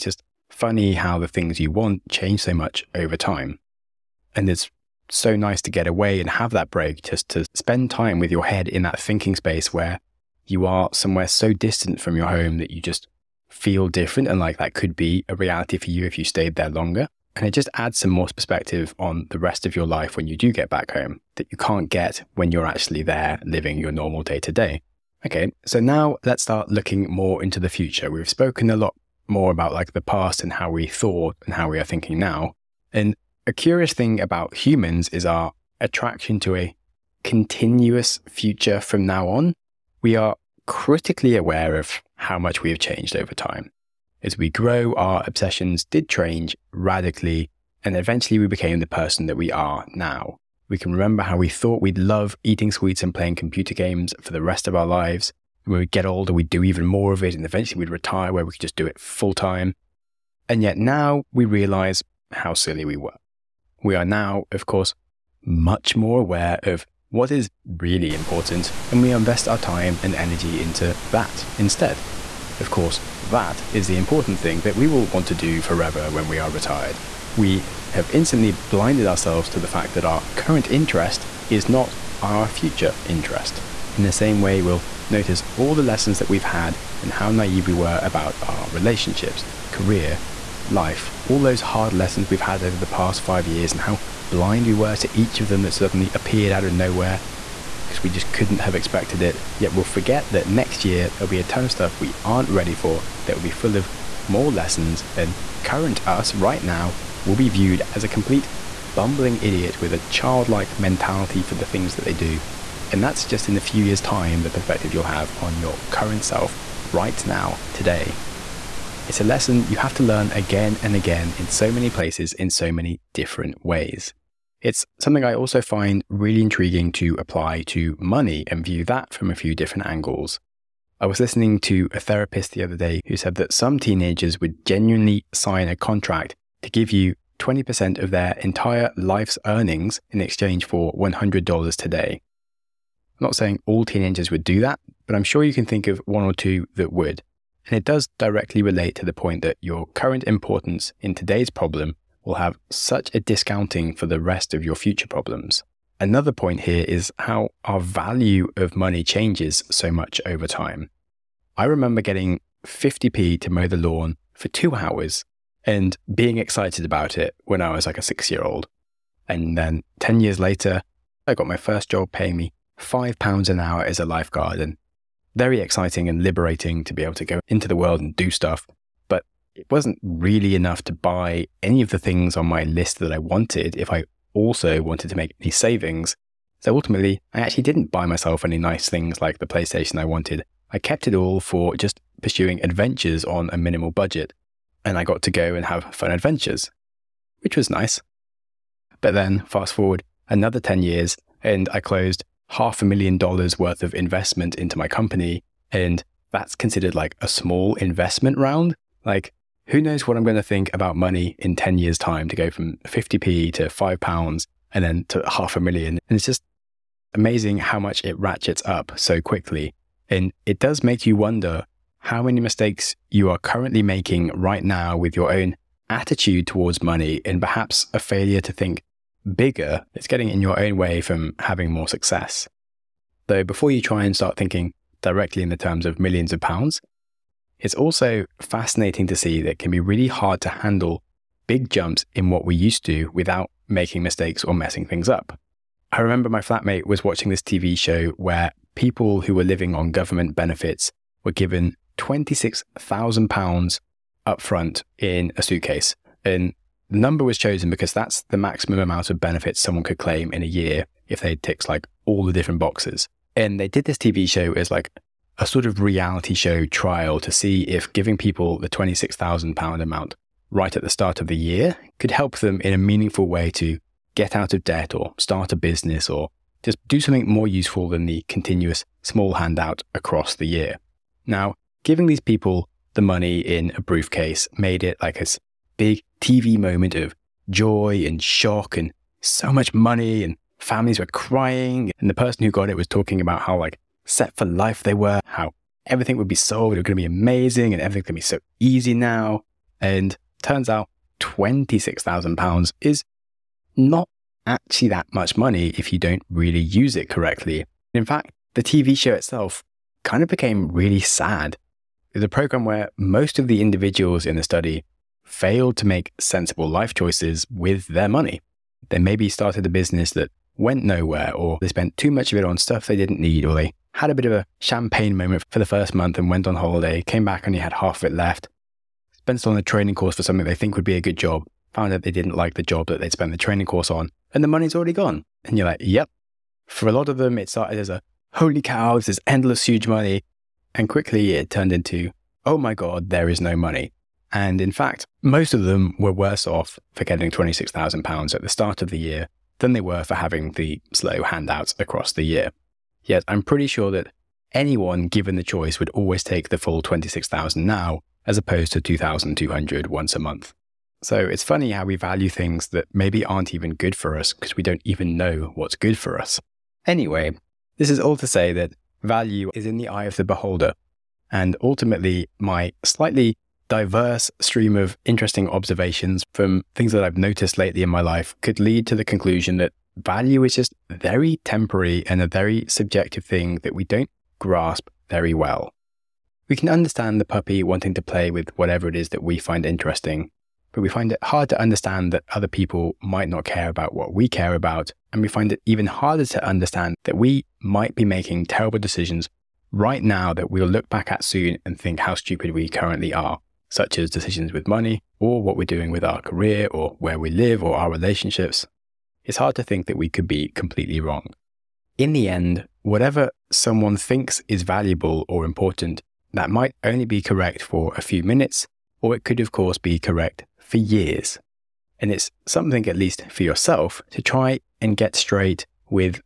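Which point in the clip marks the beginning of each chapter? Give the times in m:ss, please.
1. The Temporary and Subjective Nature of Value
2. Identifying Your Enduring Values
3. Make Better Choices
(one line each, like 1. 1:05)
1. 0:45
2. 2:54
3. 4:46.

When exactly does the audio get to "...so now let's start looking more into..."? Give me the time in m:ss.
0:25.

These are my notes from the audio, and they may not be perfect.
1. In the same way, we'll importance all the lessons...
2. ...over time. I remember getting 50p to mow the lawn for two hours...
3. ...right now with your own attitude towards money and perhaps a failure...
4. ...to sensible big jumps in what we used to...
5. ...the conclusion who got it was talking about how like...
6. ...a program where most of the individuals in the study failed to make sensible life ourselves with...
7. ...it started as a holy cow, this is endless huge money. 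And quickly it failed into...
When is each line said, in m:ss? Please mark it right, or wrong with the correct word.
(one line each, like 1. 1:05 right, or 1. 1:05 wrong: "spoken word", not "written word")
1. 1:23 wrong: "notice", not "importance"
2. 2:40 right
3. 3:44 right
4. 4:00 wrong: "handle", not "sensible"
5. 4:52 wrong: "person", not "conclusion"
6. 5:12 wrong: "choices", not "ourselves"
7. 5:37 wrong: "turned", not "failed".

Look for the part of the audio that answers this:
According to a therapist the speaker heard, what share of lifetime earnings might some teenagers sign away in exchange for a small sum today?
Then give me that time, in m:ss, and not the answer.
2:17.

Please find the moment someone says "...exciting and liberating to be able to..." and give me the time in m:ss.
2:55.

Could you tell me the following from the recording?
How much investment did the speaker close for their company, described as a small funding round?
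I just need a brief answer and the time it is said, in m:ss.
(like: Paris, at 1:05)
half a million dollars, at 3:22.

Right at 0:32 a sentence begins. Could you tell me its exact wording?
And a curious thing about humans is our attraction to a continuous future from now on.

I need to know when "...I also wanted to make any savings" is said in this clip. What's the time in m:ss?
3:03.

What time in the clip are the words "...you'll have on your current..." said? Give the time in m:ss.
1:54.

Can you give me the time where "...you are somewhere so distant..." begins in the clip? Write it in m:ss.
0:10.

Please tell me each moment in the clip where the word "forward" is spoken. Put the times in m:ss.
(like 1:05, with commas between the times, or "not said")
3:19.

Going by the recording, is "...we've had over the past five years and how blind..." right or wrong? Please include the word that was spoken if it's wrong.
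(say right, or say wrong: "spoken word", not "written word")
right.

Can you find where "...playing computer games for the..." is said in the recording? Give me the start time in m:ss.
0:53.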